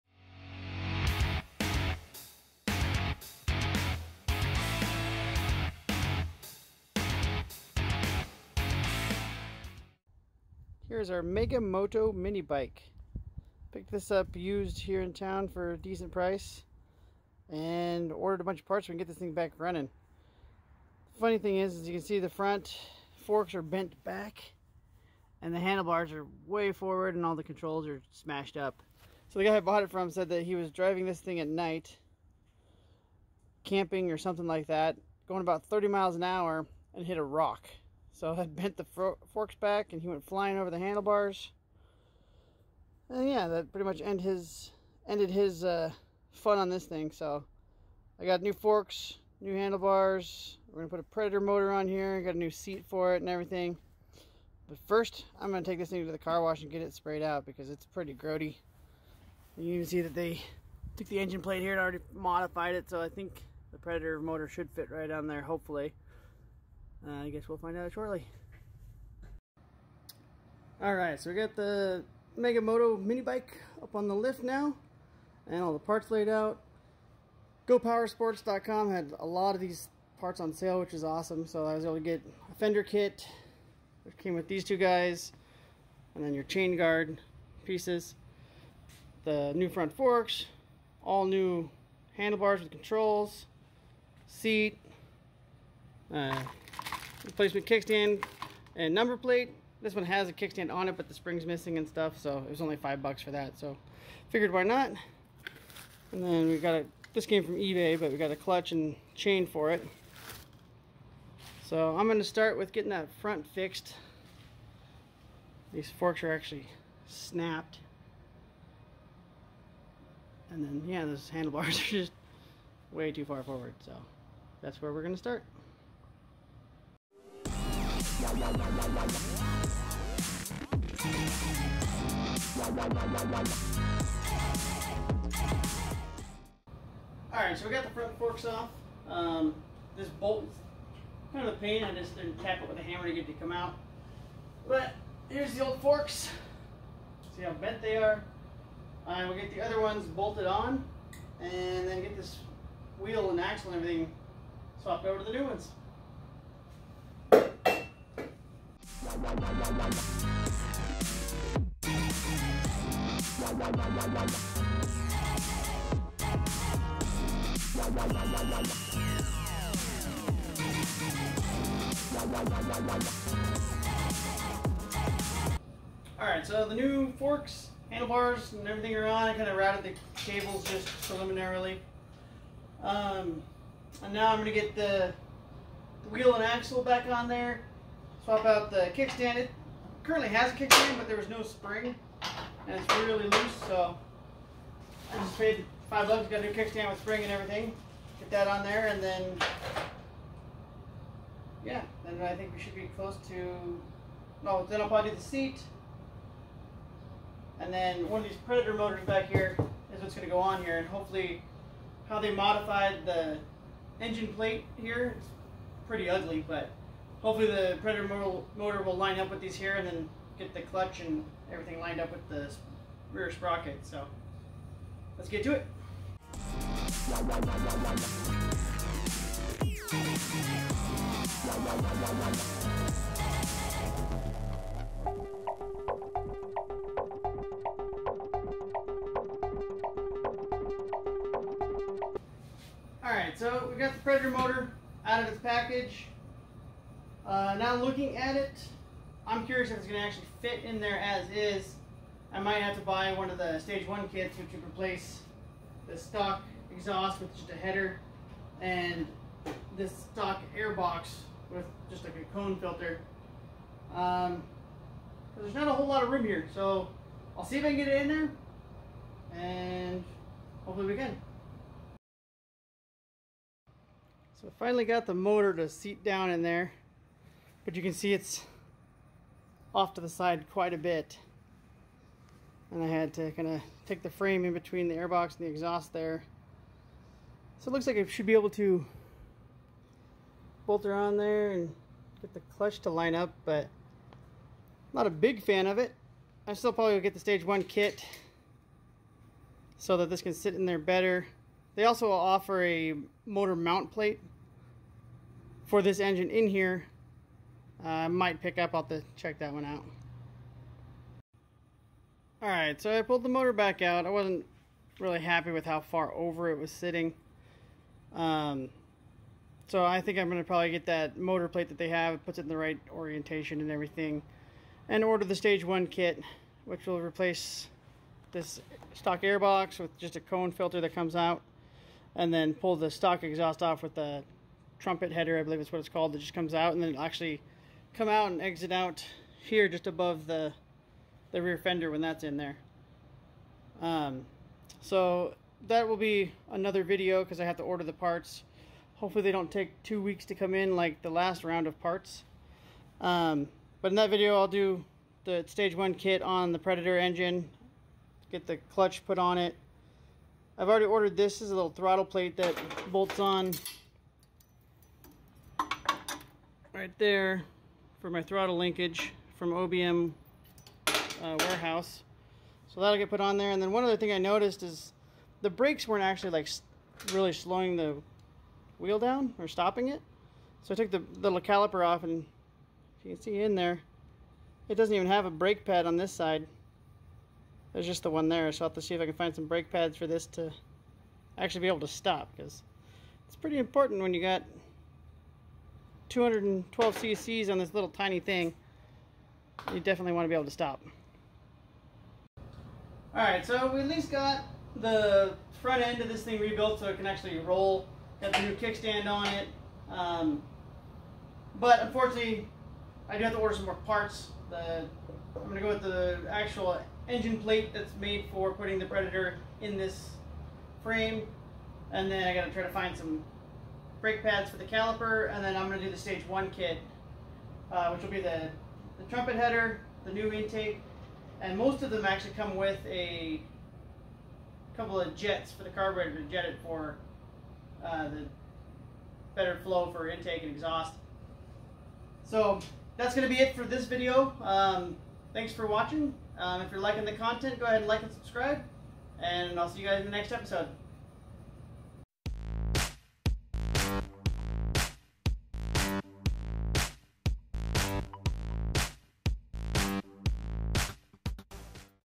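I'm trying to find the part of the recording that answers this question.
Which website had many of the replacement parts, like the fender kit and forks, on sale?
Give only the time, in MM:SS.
01:17.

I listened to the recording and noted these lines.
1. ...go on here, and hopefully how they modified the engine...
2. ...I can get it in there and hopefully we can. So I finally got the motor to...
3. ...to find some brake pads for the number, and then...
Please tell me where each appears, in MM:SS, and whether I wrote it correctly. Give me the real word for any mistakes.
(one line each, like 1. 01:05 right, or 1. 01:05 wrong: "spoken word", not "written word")
1. 03:30 right
2. 04:27 right
3. 07:02 wrong: "caliper", not "number".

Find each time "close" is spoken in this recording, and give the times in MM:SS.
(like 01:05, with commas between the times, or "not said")
03:22.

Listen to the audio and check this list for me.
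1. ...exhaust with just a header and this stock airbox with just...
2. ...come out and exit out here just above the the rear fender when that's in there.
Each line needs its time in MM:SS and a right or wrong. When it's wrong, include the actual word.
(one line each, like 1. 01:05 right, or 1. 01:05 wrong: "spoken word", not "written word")
1. 04:16 right
2. 05:37 right.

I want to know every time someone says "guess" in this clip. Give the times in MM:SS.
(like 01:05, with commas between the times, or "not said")
01:07.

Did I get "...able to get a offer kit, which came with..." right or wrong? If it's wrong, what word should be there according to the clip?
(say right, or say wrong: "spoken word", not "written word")
wrong: "fender", not "offer".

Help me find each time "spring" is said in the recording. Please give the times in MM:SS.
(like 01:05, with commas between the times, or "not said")
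01:41, 03:11, 03:16.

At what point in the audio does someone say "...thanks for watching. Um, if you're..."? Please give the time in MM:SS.
07:25.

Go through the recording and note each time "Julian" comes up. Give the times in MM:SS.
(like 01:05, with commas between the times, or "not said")
not said.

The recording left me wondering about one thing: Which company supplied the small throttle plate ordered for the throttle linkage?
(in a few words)
OBM.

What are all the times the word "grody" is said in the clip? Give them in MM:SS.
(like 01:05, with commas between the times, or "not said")
00:58.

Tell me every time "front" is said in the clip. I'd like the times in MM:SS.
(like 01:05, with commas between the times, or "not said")
00:22, 01:29, 01:53, 02:17, 06:45.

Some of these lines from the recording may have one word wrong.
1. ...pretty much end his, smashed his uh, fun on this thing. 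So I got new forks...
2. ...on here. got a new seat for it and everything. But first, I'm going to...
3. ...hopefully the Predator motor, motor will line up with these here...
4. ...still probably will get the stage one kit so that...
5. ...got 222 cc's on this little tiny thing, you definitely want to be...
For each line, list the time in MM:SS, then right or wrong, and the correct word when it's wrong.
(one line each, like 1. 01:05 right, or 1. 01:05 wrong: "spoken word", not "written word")
1. 00:43 wrong: "ended", not "smashed"
2. 00:51 right
3. 03:37 right
4. 04:56 right
5. 06:34 wrong: "212", not "222".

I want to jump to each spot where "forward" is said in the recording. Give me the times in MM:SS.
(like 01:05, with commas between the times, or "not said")
00:26, 02:03.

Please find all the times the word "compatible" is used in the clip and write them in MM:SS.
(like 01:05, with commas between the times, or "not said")
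not said.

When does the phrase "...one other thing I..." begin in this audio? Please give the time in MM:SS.
06:13.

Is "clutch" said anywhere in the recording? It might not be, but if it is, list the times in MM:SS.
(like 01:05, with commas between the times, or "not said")
01:48, 03:40, 04:52, 05:58.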